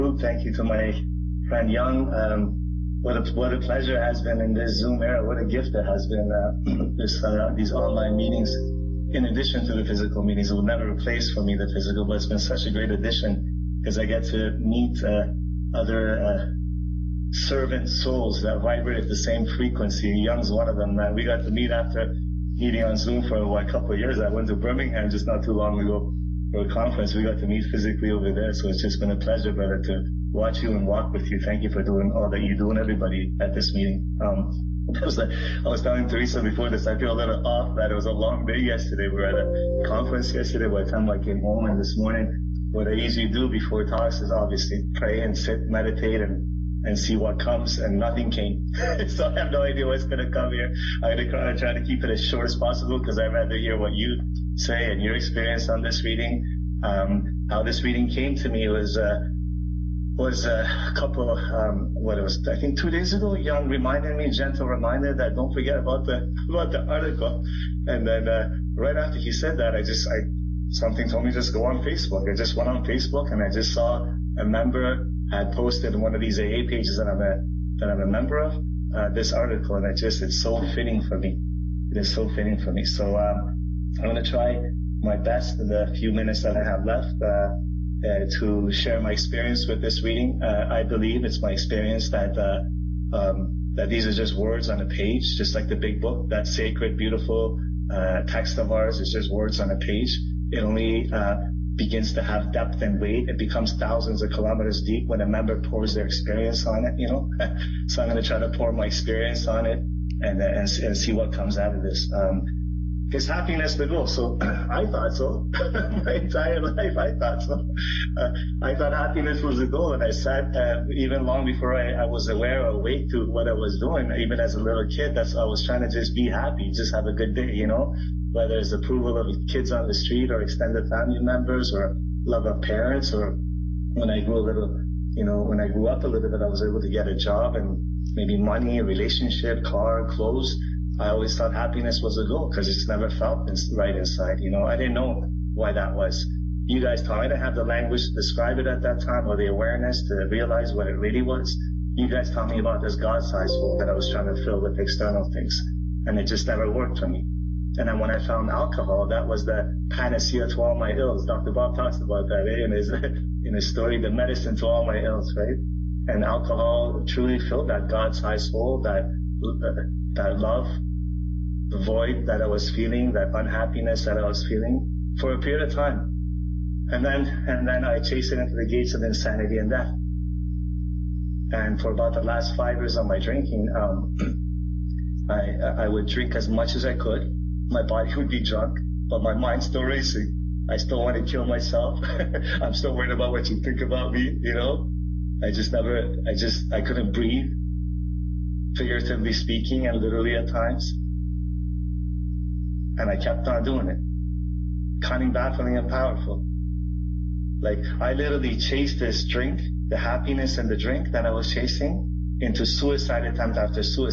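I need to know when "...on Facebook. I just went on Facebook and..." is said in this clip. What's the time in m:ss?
1:11.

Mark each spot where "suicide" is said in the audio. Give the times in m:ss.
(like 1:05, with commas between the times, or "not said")
3:32.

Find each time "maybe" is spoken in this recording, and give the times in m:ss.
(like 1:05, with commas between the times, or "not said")
2:18.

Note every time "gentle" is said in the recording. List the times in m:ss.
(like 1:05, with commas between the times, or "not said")
1:04.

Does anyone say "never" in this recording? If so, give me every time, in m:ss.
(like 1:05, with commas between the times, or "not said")
0:10, 2:22, 2:36, 3:15.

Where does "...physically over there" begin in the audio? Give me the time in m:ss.
0:27.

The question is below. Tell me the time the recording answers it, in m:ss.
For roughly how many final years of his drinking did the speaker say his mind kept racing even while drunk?
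3:02.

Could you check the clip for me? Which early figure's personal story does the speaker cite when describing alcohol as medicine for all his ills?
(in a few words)
Dr. Bob.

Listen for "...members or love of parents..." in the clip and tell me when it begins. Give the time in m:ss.
2:11.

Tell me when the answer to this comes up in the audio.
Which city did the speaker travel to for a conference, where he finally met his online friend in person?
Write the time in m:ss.
0:24.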